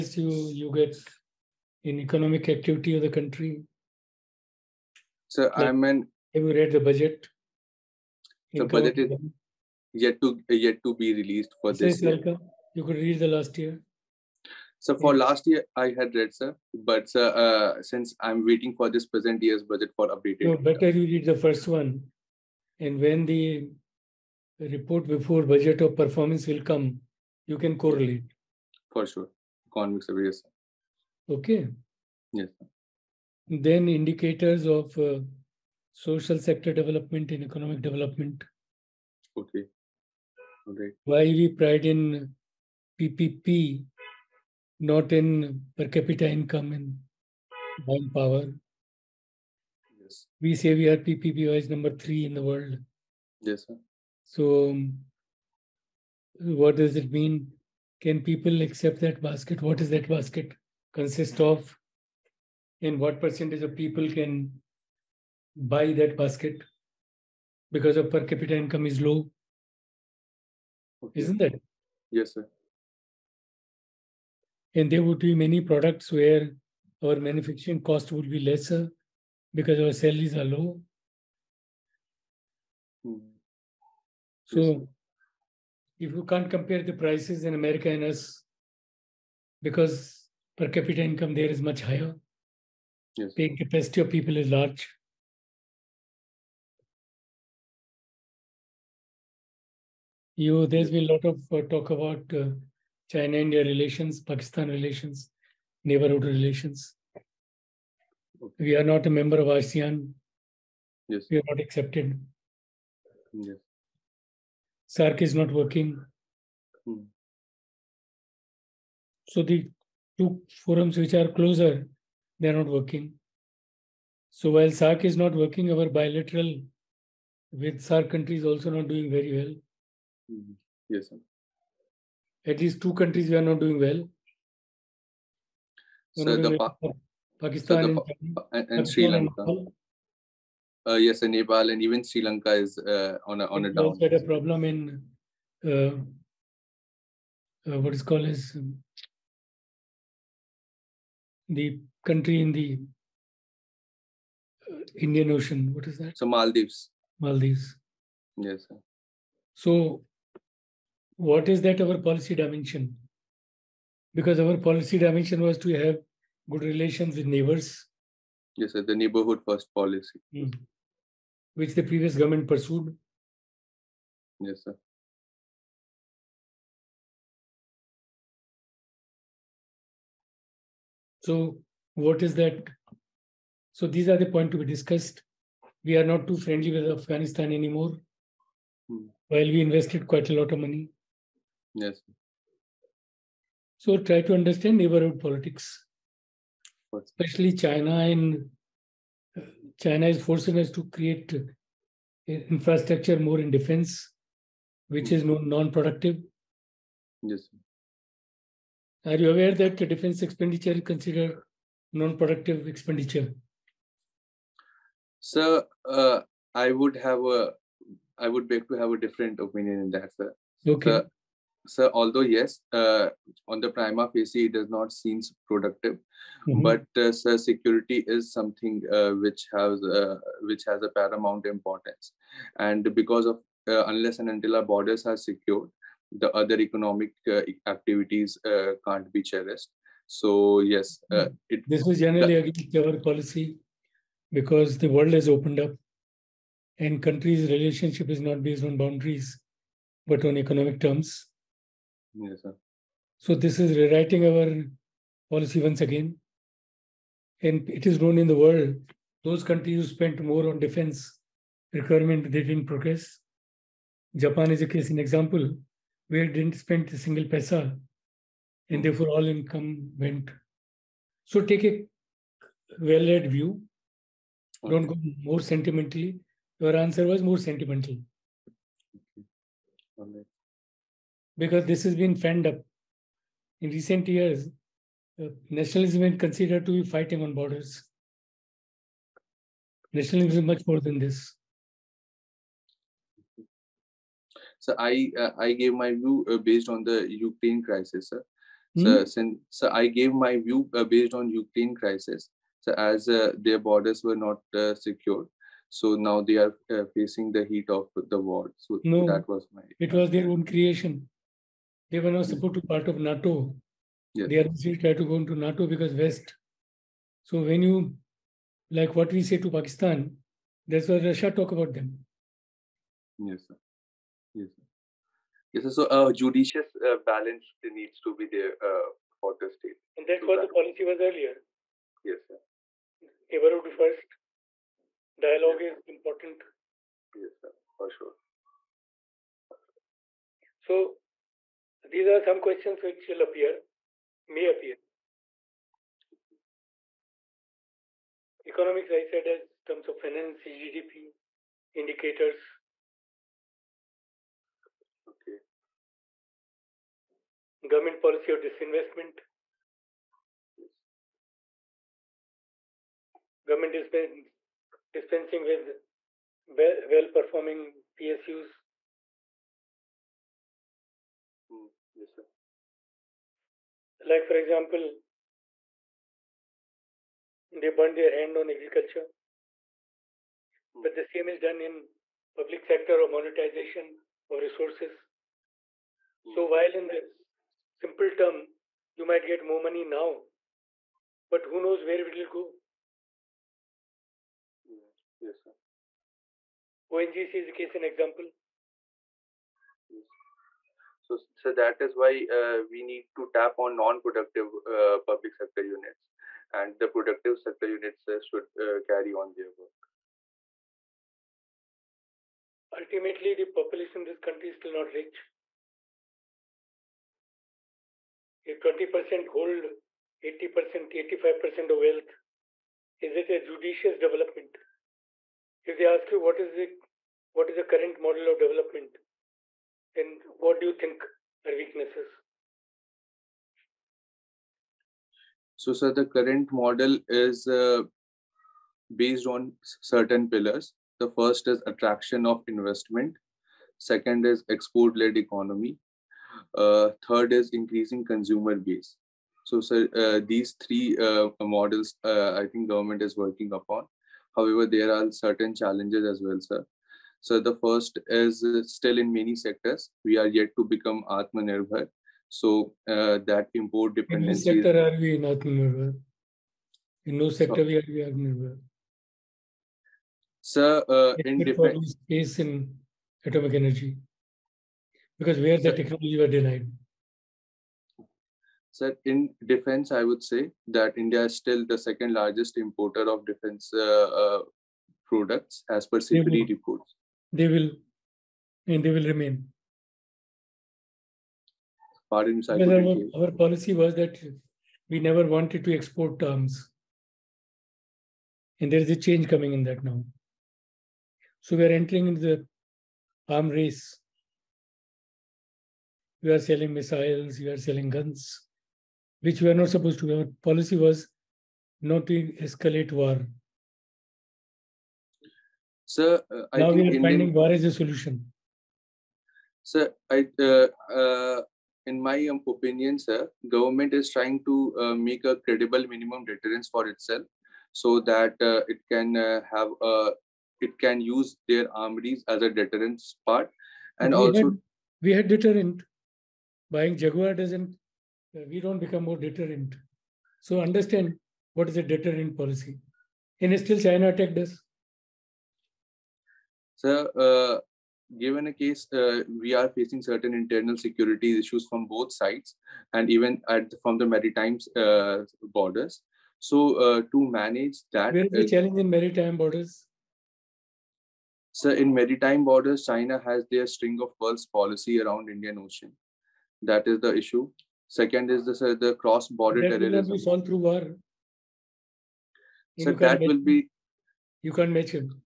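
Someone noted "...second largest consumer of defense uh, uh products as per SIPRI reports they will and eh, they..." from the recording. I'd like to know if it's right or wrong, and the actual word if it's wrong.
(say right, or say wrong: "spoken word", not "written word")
wrong: "importer", not "consumer".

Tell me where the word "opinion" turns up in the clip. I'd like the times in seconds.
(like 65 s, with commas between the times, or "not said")
219 s, 522 s.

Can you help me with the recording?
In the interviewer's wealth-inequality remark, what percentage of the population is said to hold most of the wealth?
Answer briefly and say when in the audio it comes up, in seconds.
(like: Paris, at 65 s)
20%, at 418 s.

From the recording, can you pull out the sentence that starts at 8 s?
The budget is yet to yet to be released for this year.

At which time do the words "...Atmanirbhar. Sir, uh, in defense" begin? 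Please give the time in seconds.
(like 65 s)
468 s.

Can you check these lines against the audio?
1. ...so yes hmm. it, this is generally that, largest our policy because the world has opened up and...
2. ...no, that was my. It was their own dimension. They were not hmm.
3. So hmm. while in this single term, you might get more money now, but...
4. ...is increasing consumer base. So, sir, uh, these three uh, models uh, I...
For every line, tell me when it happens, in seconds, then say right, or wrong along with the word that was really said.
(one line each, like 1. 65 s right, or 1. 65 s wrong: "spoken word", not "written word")
1. 240 s wrong: "against", not "largest"
2. 308 s wrong: "creation", not "dimension"
3. 386 s wrong: "simple", not "single"
4. 447 s right.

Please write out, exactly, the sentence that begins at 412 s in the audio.
Ultimately, the population in this country is still not rich.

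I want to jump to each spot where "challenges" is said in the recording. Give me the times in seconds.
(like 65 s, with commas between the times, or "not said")
455 s, 558 s.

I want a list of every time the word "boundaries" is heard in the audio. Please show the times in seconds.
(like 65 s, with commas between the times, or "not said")
248 s.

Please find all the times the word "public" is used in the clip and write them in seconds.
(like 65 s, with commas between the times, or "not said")
382 s, 404 s.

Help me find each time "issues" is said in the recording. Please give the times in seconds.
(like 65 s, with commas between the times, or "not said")
551 s, 567 s.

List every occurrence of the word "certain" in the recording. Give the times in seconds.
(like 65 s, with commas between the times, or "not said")
439 s, 455 s, 550 s.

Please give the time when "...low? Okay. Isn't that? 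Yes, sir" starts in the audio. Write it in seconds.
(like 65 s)
68 s.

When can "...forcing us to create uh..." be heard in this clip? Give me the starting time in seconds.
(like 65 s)
200 s.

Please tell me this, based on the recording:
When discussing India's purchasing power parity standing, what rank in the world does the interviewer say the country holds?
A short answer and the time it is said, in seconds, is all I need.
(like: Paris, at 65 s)
3, at 51 s.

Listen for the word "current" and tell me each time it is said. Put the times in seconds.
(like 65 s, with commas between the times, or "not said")
427 s, 436 s.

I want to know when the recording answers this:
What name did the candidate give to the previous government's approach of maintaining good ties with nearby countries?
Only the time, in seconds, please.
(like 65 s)
168 s.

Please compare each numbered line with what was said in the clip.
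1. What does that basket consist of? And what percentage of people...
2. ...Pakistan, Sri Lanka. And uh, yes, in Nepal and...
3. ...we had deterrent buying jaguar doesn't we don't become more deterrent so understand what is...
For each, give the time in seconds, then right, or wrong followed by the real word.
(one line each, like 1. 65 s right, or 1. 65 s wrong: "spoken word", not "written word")
1. 59 s right
2. 138 s right
3. 535 s right.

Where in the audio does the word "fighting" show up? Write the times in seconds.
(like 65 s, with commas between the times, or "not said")
286 s.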